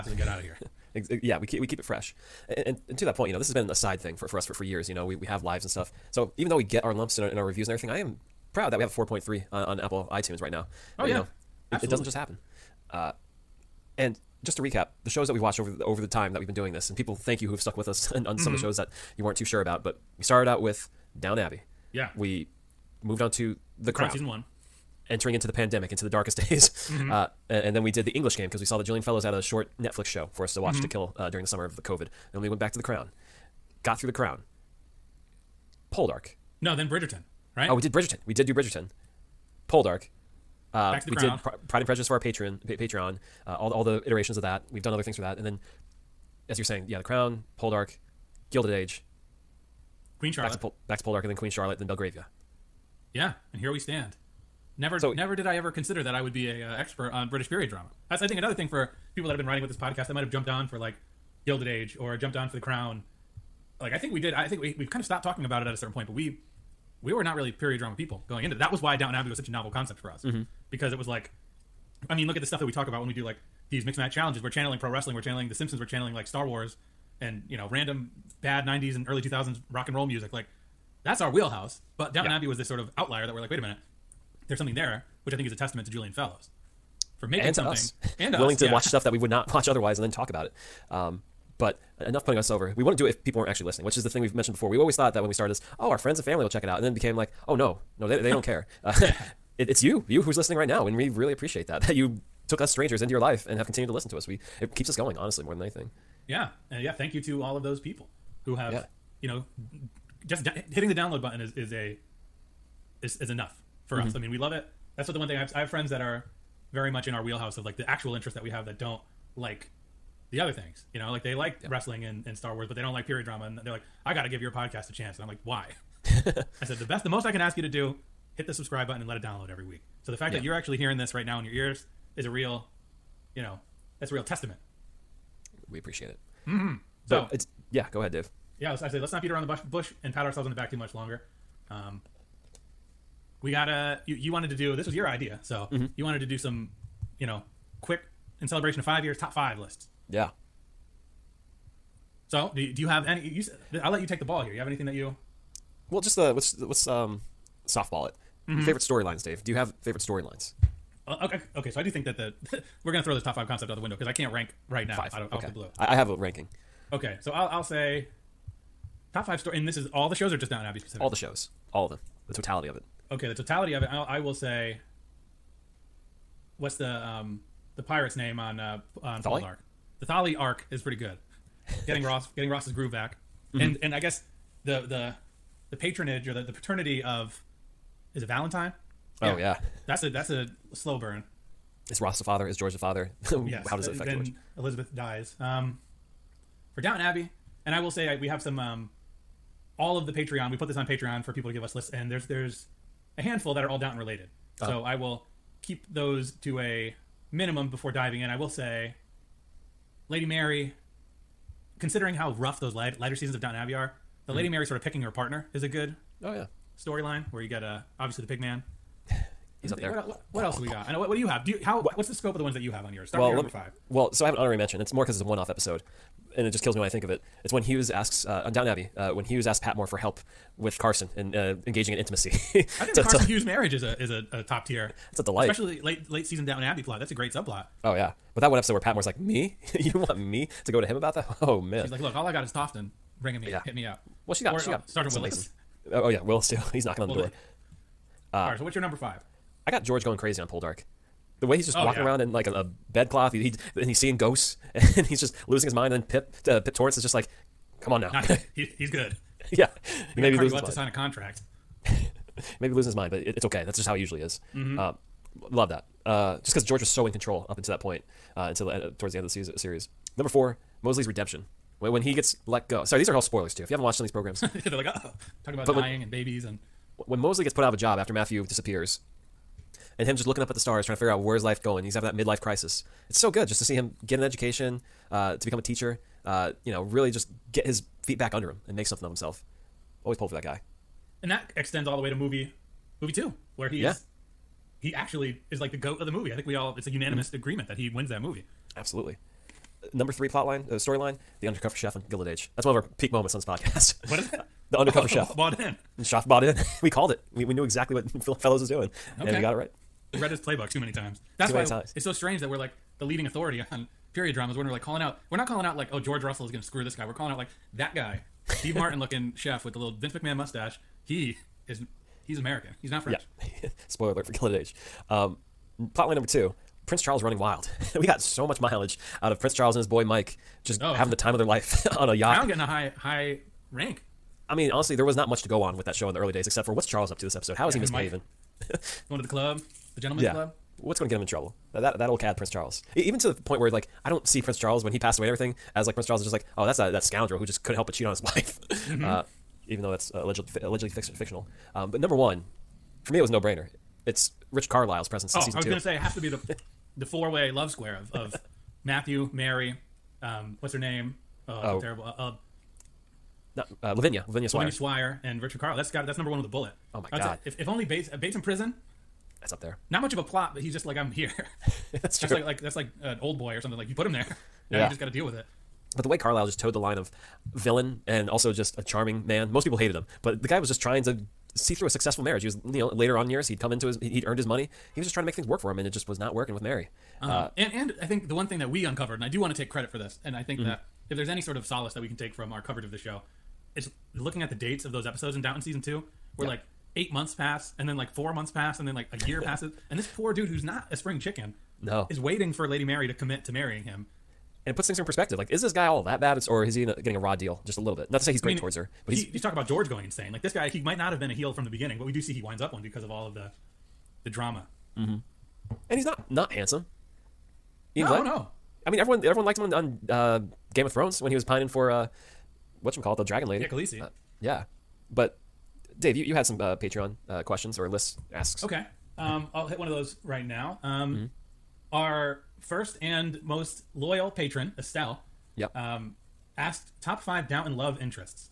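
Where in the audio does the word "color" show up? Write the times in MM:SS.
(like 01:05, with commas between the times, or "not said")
not said.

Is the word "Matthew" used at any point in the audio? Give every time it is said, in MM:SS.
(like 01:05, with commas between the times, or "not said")
04:38, 05:58.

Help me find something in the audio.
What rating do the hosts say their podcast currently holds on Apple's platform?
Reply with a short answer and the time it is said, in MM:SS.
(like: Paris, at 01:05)
4.3, at 00:08.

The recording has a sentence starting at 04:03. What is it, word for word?
hit me up." Well, she got or, she uh, got uh, Sergeant Willis.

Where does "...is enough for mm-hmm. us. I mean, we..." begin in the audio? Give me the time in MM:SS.
01:53.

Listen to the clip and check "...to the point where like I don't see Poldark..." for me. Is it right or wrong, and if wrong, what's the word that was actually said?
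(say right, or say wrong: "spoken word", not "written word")
wrong: "Prince", not "Poldark".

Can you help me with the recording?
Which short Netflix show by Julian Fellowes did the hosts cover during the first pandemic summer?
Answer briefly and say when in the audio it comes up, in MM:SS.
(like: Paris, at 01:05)
The English Game, at 00:28.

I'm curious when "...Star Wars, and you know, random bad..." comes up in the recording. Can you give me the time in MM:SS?
01:16.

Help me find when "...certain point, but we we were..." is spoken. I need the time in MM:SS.
01:05.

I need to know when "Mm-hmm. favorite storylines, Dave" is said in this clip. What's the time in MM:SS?
02:38.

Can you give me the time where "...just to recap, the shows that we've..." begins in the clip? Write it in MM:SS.
00:14.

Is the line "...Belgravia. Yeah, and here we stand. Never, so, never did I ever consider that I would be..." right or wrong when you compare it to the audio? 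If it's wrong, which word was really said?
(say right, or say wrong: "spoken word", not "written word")
right.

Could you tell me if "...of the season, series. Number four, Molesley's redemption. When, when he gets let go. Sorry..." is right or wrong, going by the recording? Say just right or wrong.
right.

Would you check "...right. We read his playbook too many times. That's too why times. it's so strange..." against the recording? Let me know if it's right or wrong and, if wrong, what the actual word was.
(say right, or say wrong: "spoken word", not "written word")
right.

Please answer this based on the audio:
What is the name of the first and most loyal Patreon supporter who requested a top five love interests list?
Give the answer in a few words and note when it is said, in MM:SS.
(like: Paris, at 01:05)
Estelle, at 07:14.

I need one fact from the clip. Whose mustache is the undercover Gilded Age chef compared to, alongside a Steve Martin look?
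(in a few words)
Vince McMahon.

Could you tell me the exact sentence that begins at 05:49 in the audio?
uh, even though that's uh, allegedly fi- allegedly fictional.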